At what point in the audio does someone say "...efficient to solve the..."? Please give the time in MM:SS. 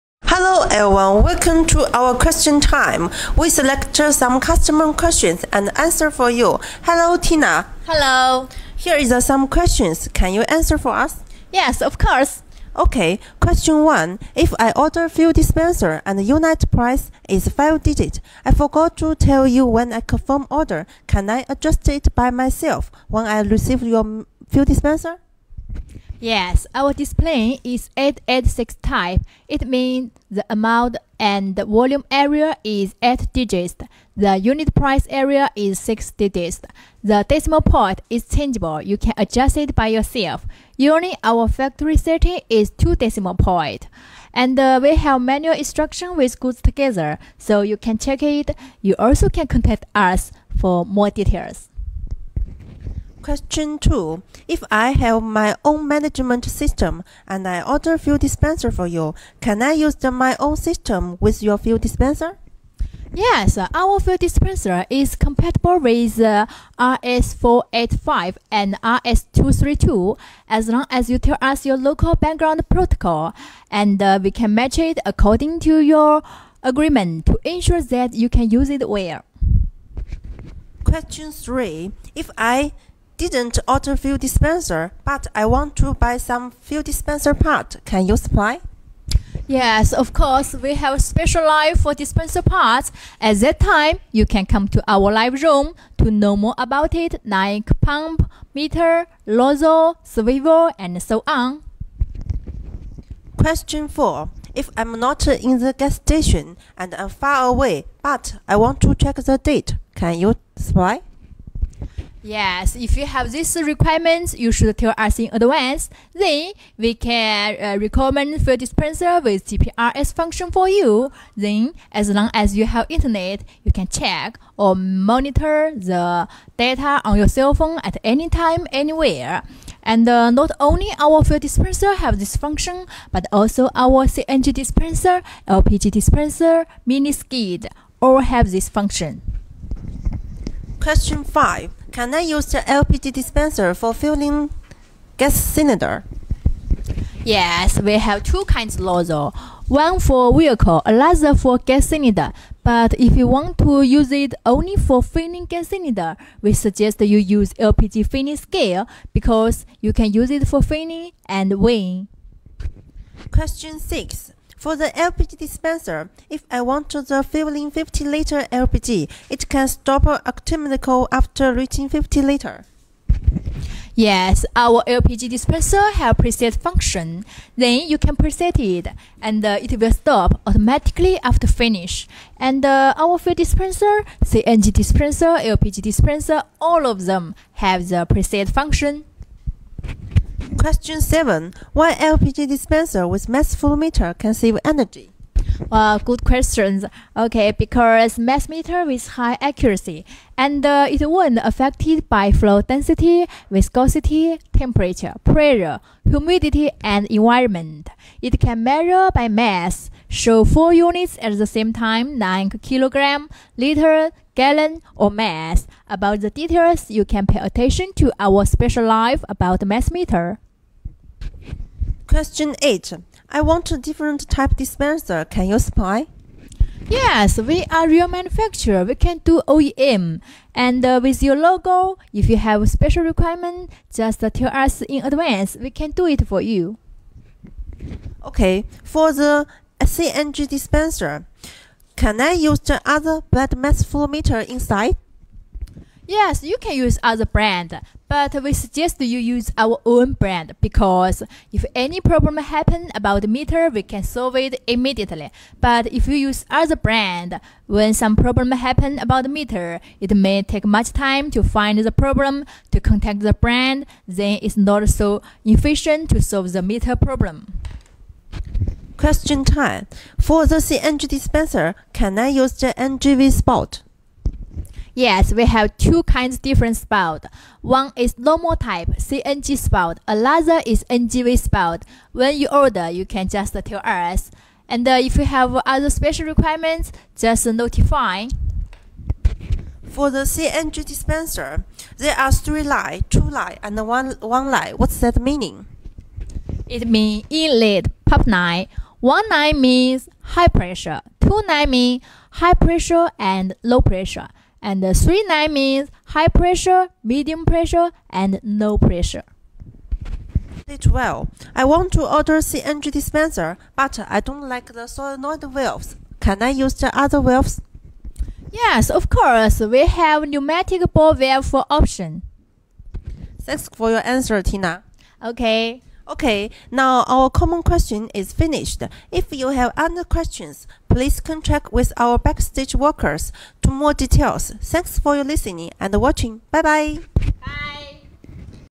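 04:25.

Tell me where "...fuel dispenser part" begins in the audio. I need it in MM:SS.
01:26.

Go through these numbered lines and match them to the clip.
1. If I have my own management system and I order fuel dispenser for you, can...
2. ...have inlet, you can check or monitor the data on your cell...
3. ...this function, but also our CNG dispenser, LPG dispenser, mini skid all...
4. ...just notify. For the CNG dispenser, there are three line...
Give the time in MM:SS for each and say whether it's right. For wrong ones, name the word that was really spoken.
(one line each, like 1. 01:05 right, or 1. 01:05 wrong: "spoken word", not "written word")
1. 00:54 right
2. 02:02 wrong: "internet", not "inlet"
3. 02:12 right
4. 04:47 right.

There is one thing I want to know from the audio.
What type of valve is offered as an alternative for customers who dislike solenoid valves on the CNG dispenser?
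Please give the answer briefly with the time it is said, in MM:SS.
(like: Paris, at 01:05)
Pneumatic ball valve, at 05:20.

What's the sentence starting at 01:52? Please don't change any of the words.
Yes, if you have these requirements, you should tell us in advance.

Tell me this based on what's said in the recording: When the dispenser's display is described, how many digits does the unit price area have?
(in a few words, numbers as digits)
6.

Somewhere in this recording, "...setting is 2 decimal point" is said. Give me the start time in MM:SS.
00:41.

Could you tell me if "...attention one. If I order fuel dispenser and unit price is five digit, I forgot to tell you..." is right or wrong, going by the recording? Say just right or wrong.
wrong.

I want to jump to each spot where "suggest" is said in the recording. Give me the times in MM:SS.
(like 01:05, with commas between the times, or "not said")
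02:36, 04:08.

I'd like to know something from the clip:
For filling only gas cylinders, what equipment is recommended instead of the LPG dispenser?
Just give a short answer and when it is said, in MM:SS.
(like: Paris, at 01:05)
LPG filling scale, at 02:37.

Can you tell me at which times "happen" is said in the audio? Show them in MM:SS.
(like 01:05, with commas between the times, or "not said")
04:12, 04:18.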